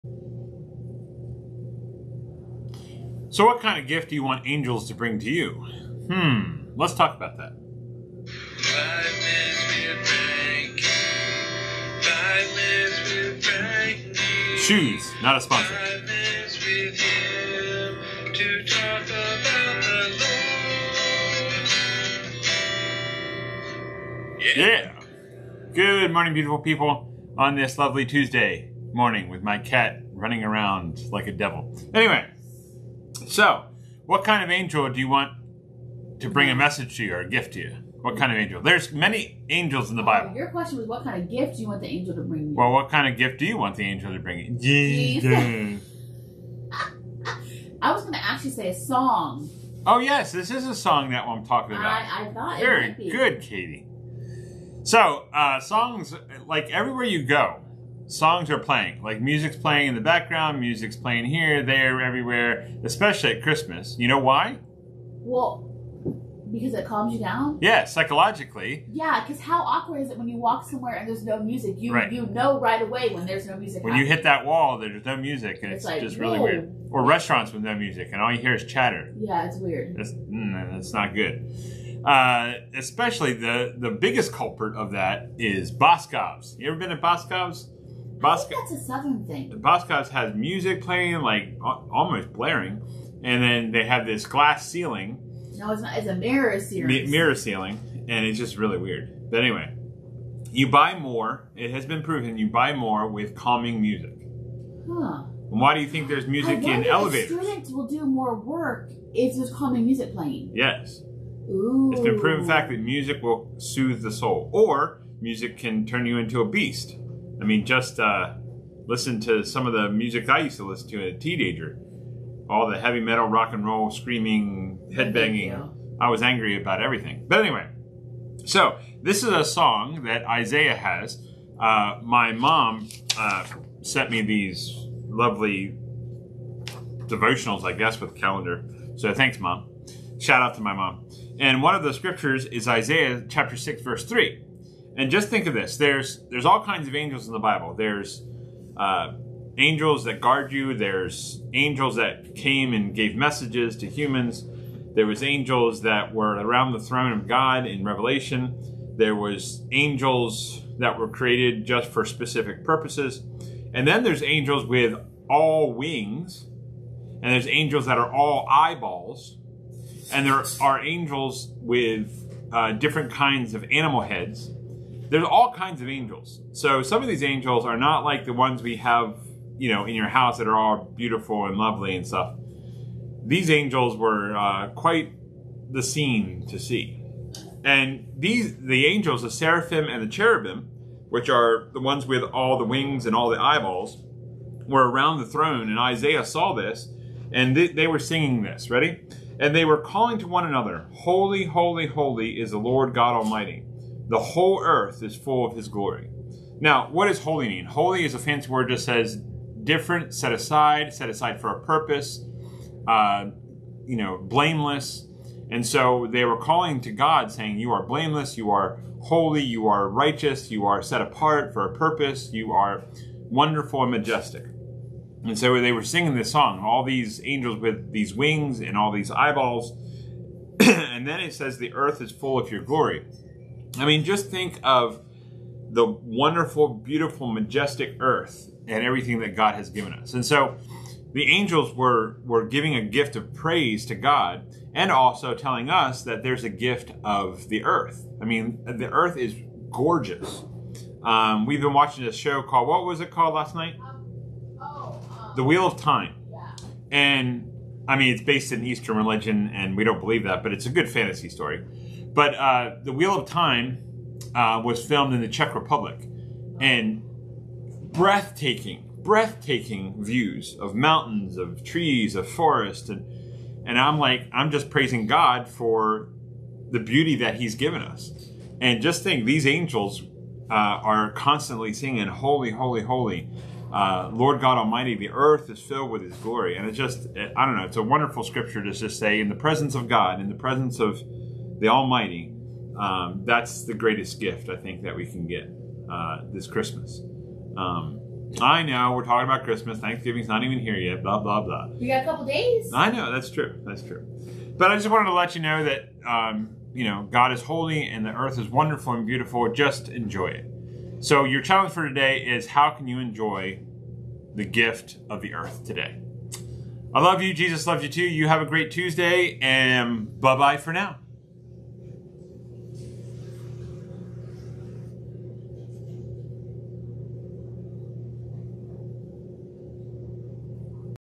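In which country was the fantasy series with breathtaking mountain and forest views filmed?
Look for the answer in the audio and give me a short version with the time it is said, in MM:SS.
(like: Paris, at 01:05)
Czech Republic, at 04:25.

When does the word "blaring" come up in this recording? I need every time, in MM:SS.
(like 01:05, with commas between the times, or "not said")
01:32.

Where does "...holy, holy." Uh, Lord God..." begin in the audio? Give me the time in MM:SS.
04:42.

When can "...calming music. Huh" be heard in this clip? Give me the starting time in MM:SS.
01:43.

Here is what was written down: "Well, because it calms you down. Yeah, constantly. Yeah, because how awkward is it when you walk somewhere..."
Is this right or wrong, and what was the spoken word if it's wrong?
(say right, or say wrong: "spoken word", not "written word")
wrong: "psychologically", not "constantly".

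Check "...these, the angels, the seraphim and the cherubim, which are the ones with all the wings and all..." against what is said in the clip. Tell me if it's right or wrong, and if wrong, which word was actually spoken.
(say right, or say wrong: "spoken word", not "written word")
right.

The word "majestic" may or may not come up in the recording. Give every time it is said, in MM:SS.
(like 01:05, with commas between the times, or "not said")
03:43, 03:57.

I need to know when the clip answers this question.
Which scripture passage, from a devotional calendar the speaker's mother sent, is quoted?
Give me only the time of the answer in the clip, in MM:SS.
02:22.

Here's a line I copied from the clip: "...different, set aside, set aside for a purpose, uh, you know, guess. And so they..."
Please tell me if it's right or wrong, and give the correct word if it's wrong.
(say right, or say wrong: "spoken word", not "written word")
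wrong: "blameless", not "guess".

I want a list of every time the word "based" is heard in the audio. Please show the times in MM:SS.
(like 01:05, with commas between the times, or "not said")
04:18.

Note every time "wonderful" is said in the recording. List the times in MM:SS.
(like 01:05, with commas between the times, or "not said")
03:43, 03:55, 04:47, 05:08.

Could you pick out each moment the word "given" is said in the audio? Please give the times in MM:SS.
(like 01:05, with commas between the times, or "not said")
03:59, 04:37.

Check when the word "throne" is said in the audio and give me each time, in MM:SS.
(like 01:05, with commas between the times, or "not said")
02:36, 03:15.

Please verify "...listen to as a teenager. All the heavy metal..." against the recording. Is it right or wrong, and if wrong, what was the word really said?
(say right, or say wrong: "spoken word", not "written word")
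right.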